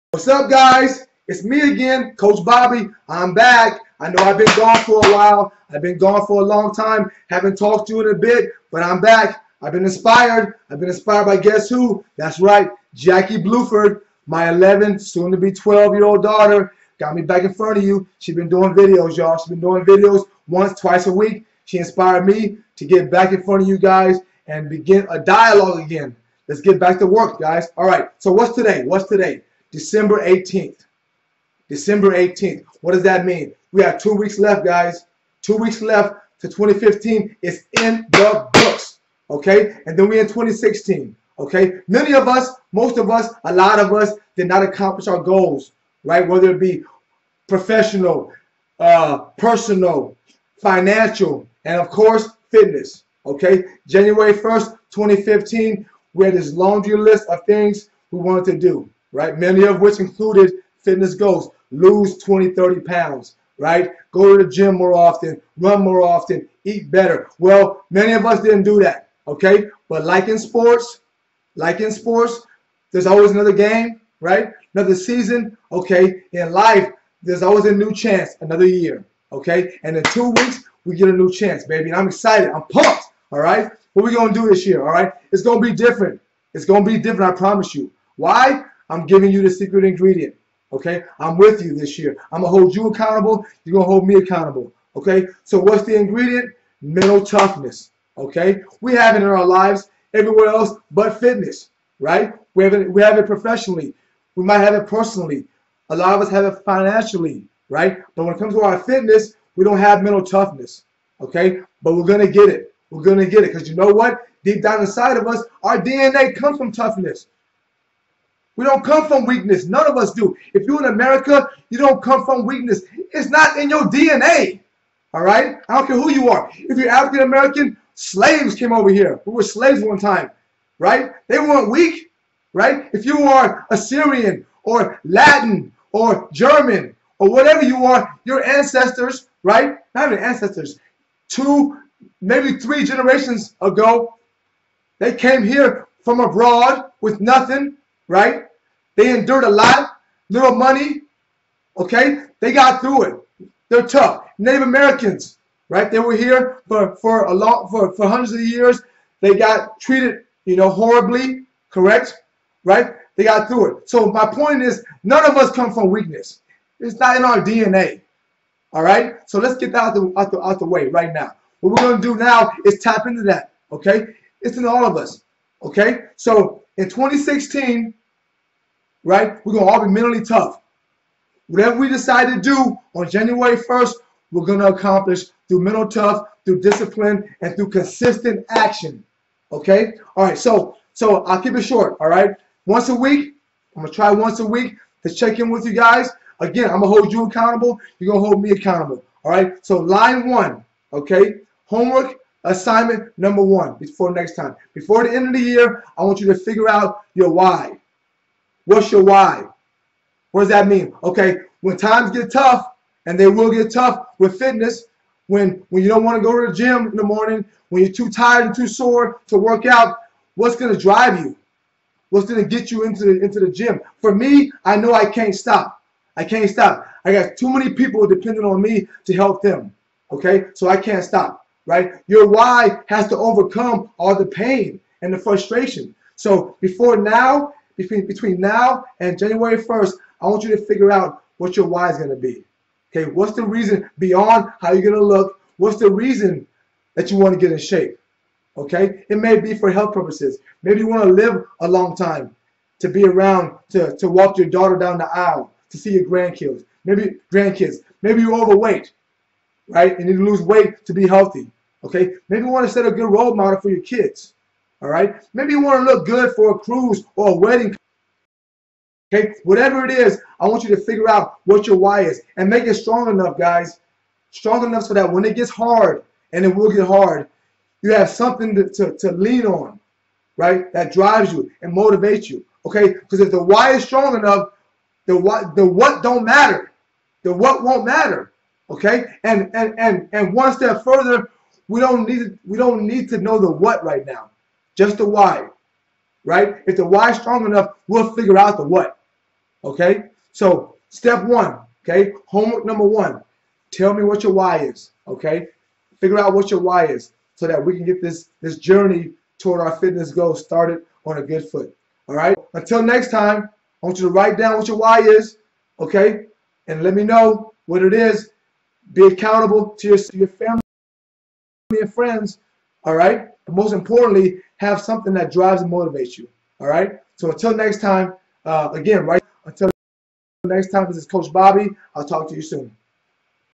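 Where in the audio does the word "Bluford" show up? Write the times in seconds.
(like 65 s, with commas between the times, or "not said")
13 s.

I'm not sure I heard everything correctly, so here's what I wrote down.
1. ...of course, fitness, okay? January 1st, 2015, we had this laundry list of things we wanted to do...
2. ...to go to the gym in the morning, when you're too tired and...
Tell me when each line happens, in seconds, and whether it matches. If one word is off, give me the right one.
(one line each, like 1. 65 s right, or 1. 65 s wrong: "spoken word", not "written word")
1. 51 s right
2. 216 s right.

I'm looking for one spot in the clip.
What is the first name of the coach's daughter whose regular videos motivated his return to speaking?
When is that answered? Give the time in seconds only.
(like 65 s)
12 s.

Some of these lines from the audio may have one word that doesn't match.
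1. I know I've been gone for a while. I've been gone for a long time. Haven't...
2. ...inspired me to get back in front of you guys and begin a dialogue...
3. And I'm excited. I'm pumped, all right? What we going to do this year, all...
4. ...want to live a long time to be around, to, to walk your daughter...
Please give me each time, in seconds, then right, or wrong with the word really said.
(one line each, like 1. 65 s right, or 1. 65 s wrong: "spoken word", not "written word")
1. 4 s right
2. 21 s right
3. 81 s right
4. 250 s right.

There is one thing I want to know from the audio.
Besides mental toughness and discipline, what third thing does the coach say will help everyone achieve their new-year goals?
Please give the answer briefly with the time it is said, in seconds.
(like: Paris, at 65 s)
consistent action, at 187 s.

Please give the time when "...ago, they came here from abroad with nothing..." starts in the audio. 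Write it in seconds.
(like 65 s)
143 s.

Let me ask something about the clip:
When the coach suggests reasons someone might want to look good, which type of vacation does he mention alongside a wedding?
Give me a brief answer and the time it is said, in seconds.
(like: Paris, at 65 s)
A cruise, at 266 s.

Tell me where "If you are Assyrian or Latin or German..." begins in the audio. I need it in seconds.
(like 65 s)
132 s.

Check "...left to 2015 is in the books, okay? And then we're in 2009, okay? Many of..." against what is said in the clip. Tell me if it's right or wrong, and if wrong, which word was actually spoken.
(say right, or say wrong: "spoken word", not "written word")
wrong: "2016", not "2009".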